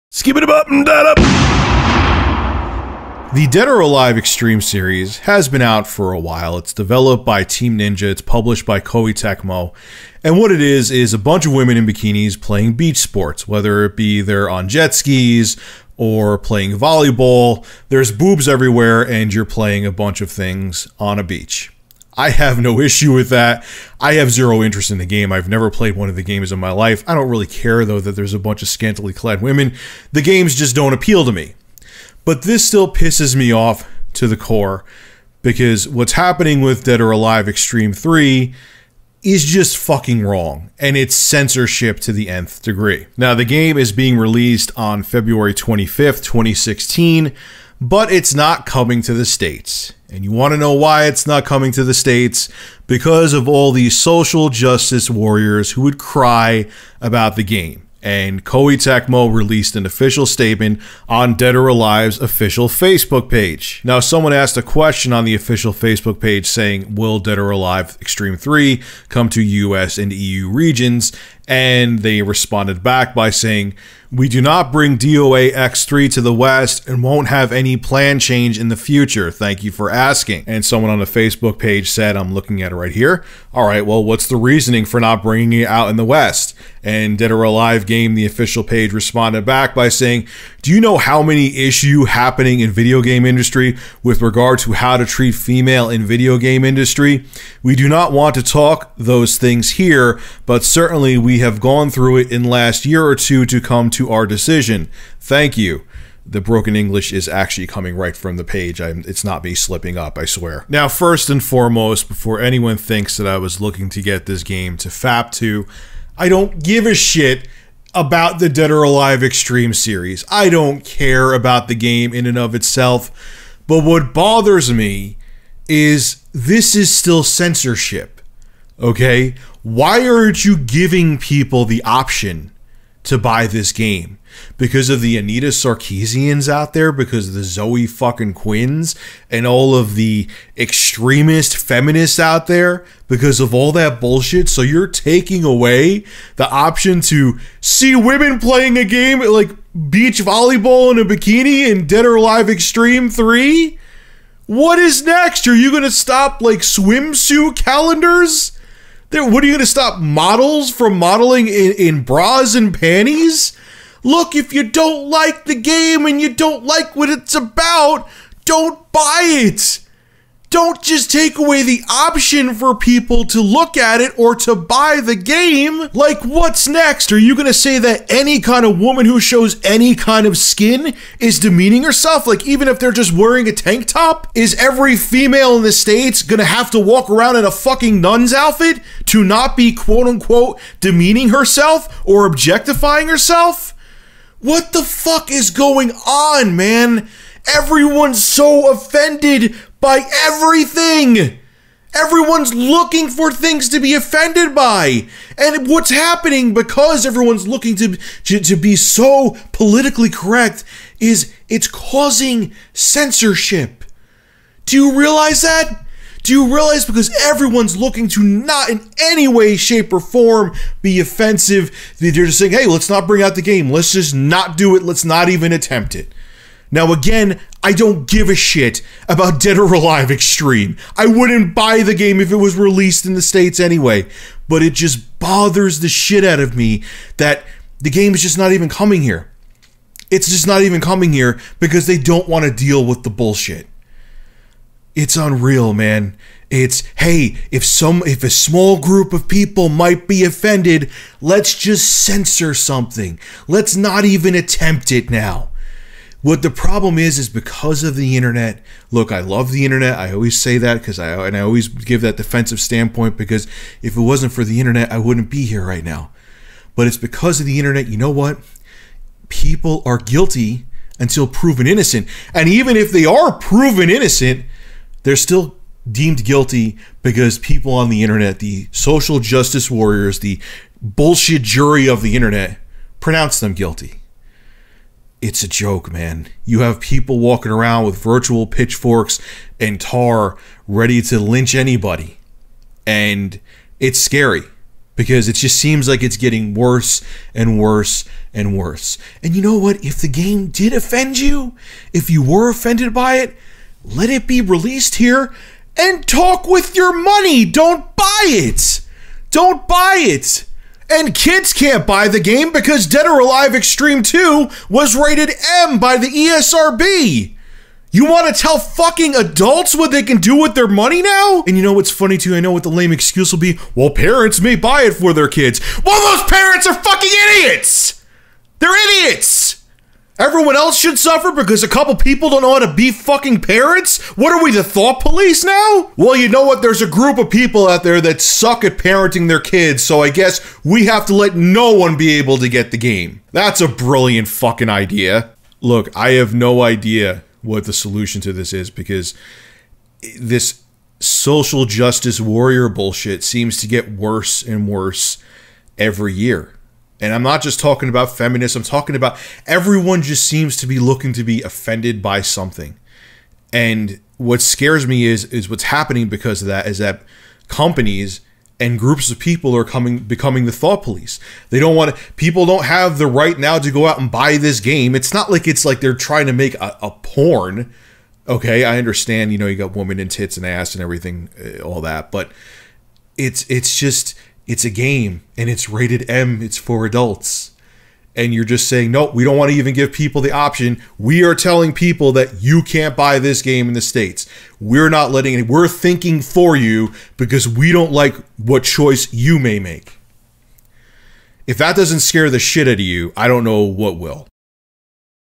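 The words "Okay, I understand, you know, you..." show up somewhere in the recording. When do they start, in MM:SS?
06:18.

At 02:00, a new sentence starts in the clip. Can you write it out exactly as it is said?
I don't care about the game in and of itself.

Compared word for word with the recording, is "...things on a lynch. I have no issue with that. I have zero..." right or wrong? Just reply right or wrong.
wrong.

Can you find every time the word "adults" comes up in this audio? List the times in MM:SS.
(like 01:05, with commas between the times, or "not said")
05:19, 06:26.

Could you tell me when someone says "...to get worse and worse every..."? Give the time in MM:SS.
05:53.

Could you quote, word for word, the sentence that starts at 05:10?
And kids can't buy the game because Dead or Alive Xtreme 2 was rated M by the ESRB.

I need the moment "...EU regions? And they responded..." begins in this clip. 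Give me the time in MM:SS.
01:10.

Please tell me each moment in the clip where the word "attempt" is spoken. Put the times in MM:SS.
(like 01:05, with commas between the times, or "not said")
03:45, 04:14.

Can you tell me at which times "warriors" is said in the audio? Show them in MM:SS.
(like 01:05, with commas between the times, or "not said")
00:55, 04:39, 05:52.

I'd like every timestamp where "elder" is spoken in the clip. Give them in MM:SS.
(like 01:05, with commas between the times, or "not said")
not said.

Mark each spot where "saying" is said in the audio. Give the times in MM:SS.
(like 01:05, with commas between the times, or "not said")
01:06, 01:13, 01:29, 03:42, 06:28.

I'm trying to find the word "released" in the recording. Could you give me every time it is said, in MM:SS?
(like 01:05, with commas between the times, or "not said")
00:44, 00:59, 03:52, 05:04.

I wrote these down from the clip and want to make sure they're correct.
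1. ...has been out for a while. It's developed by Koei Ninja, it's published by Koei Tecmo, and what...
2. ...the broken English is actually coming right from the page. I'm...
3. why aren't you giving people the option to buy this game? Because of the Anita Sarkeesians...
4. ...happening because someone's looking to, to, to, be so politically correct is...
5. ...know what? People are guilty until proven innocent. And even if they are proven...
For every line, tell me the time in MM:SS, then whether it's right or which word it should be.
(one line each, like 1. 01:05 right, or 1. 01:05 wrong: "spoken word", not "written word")
1. 00:05 wrong: "Team", not "Koei"
2. 01:46 right
3. 02:09 right
4. 03:25 wrong: "everyone", not "someone"
5. 04:27 right.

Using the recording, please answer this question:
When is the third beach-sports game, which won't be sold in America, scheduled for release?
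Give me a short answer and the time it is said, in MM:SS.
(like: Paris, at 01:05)
February 25th, 2016, at 00:45.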